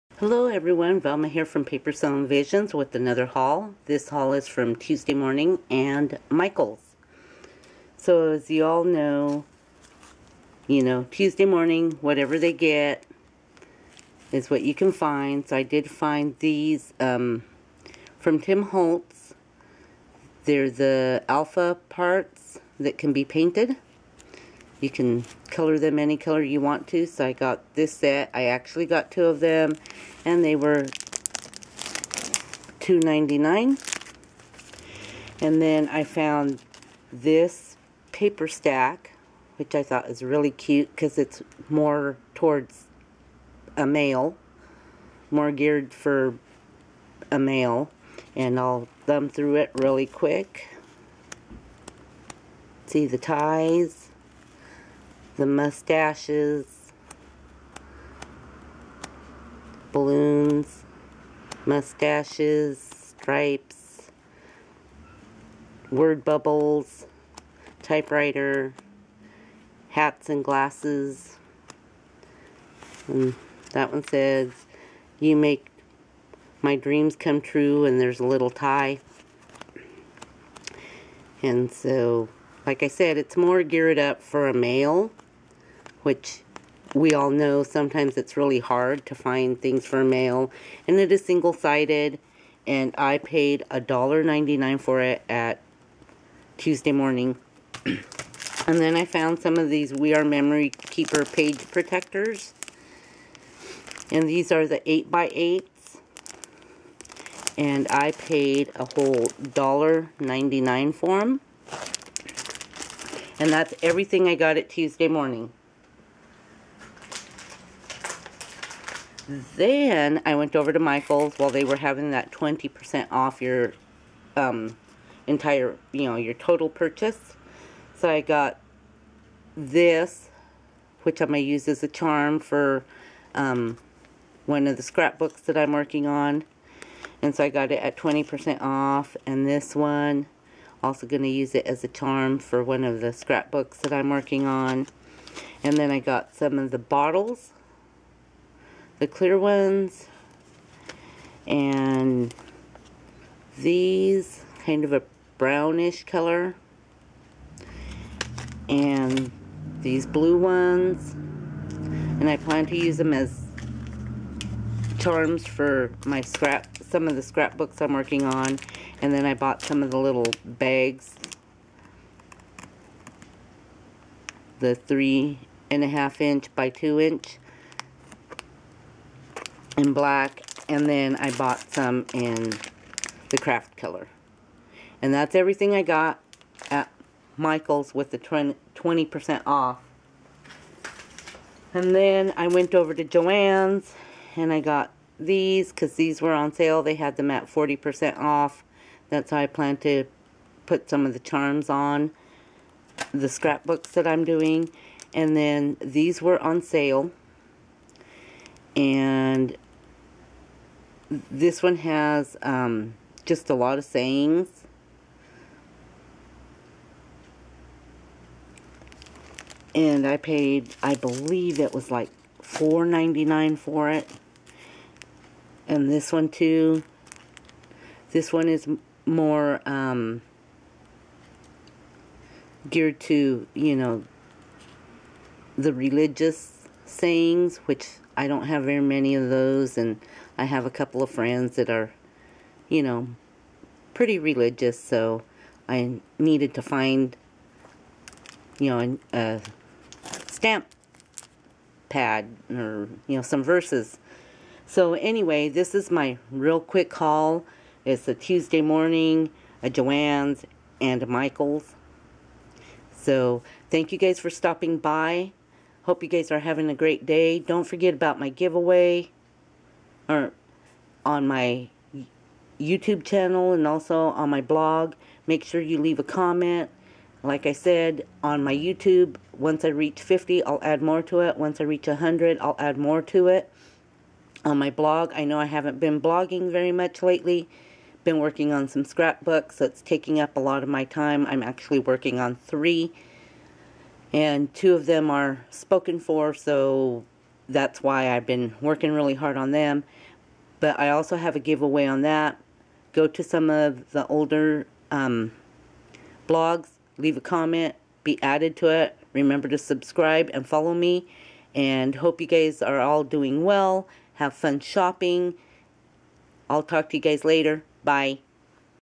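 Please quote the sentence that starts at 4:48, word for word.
Been working on some scrapbooks, so it's taking up a lot of my time.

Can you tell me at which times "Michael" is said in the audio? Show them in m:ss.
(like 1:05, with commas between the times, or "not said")
0:06, 2:00, 3:07, 4:21.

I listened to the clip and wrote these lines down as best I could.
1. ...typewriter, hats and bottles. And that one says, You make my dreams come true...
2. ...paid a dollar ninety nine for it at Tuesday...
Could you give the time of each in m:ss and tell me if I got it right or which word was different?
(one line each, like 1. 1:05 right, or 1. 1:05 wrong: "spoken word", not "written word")
1. 1:07 wrong: "glasses", not "bottles"
2. 1:33 right.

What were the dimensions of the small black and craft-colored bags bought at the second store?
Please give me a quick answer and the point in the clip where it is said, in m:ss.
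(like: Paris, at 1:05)
3.5 by 2 inches, at 2:54.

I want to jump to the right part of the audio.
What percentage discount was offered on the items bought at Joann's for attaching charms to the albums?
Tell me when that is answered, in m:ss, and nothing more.
3:17.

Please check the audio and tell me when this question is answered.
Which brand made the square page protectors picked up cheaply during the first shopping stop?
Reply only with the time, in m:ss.
1:39.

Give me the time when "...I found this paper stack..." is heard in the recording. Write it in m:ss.
0:35.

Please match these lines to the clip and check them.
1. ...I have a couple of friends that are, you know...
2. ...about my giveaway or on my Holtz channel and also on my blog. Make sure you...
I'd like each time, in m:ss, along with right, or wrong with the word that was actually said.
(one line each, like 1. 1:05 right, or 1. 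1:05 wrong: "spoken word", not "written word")
1. 4:00 right
2. 4:27 wrong: "YouTube", not "Holtz".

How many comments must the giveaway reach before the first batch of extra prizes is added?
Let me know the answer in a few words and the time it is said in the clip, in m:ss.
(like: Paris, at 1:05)
50, at 4:40.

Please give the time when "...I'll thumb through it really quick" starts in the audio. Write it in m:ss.
0:48.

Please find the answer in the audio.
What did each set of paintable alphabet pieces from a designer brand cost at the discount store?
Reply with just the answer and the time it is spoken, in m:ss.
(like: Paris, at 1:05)
$2.99, at 0:32.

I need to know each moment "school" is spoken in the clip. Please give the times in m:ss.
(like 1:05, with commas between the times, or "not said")
not said.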